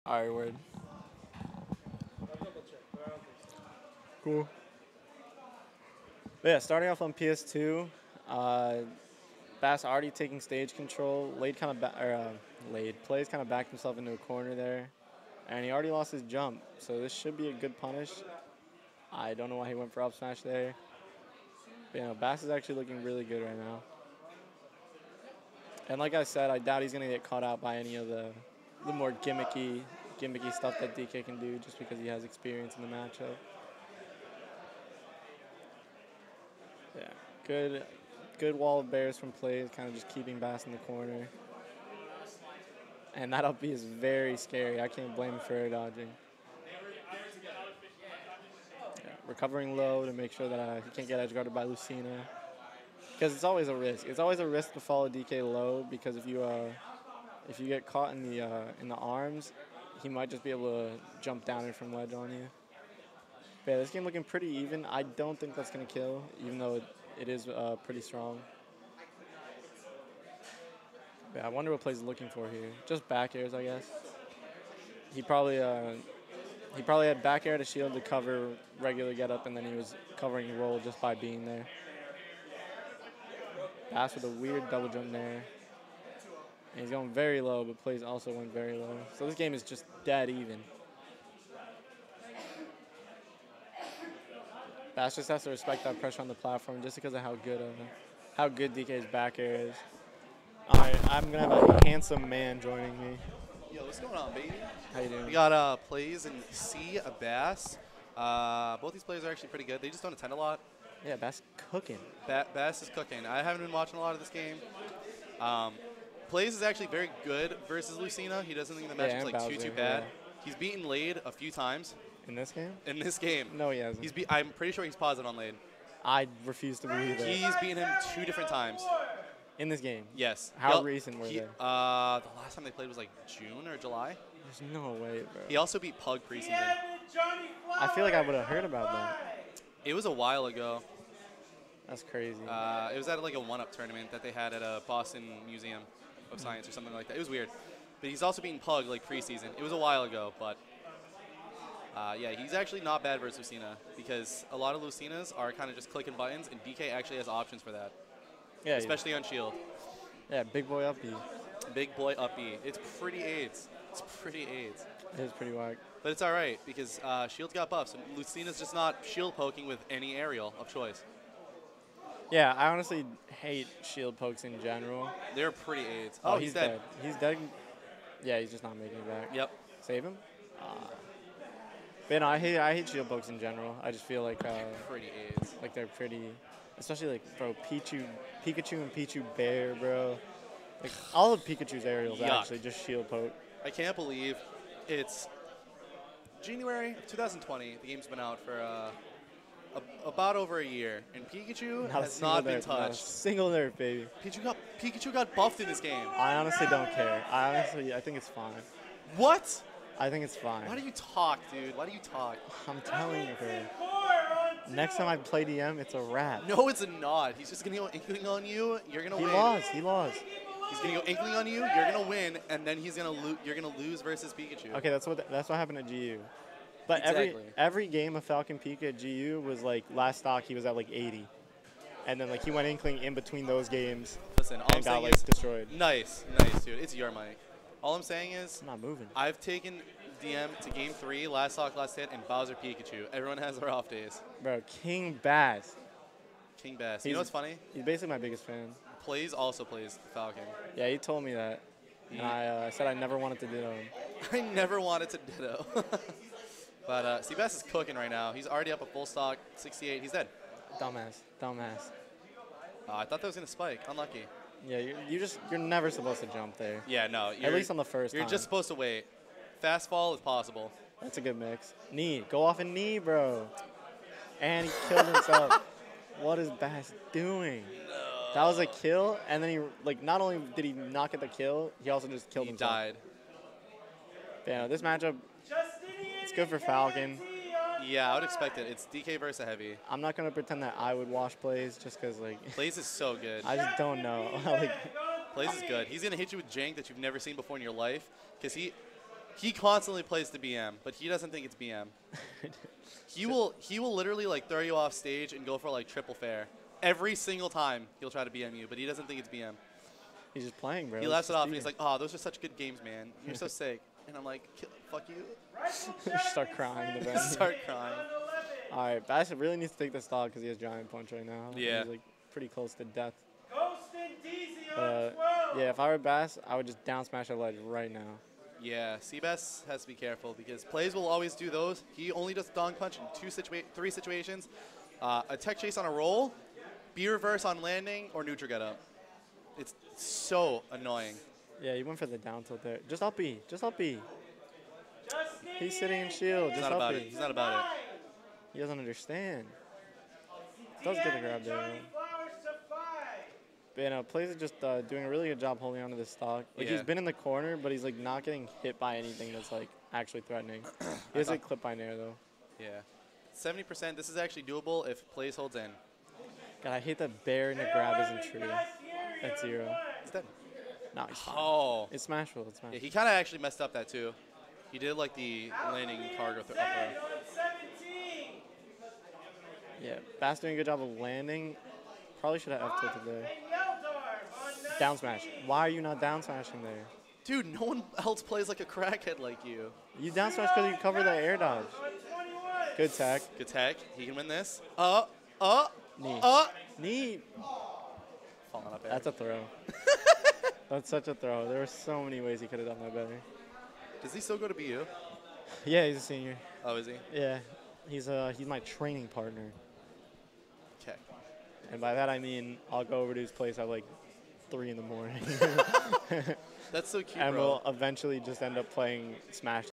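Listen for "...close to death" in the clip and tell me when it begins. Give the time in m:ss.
5:22.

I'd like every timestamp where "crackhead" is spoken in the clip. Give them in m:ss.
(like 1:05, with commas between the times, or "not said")
6:28.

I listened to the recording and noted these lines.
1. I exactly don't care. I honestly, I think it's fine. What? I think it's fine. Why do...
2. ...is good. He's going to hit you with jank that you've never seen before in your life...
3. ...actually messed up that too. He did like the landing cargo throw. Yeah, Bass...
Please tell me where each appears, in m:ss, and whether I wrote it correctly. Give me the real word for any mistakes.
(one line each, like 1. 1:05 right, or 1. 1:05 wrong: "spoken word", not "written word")
1. 3:26 wrong: "honestly", not "exactly"
2. 4:55 right
3. 6:13 right.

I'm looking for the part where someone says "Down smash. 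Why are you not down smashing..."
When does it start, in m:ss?
6:24.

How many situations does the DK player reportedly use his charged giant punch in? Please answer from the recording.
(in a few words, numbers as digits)
3.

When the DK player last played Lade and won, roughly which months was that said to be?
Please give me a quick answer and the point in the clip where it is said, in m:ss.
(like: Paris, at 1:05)
June or July, at 2:13.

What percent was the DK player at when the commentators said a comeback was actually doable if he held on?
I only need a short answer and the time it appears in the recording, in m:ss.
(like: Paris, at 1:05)
70, at 6:03.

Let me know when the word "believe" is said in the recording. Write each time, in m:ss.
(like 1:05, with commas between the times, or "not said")
2:06, 3:13.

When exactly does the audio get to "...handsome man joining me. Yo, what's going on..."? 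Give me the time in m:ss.
1:41.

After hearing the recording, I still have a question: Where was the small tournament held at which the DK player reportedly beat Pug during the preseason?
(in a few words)
Boston Museum of Science.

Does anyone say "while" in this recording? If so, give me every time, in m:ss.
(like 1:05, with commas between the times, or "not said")
2:20, 2:29.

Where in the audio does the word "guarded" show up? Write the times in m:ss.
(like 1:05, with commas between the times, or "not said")
0:51.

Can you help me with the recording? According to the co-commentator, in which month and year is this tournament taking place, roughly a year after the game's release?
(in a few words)
January 2020.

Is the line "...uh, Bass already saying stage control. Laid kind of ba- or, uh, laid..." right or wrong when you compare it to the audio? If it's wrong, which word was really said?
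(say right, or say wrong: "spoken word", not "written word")
wrong: "taking", not "saying".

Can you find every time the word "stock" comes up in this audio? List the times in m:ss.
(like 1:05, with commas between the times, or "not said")
3:50, 4:01, 4:19, 5:56.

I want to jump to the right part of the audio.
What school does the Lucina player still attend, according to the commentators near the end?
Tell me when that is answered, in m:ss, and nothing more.
6:44.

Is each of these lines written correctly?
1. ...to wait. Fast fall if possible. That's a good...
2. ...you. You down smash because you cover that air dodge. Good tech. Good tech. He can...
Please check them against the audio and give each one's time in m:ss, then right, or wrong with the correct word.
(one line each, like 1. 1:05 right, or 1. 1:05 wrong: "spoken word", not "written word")
1. 4:28 right
2. 6:29 right.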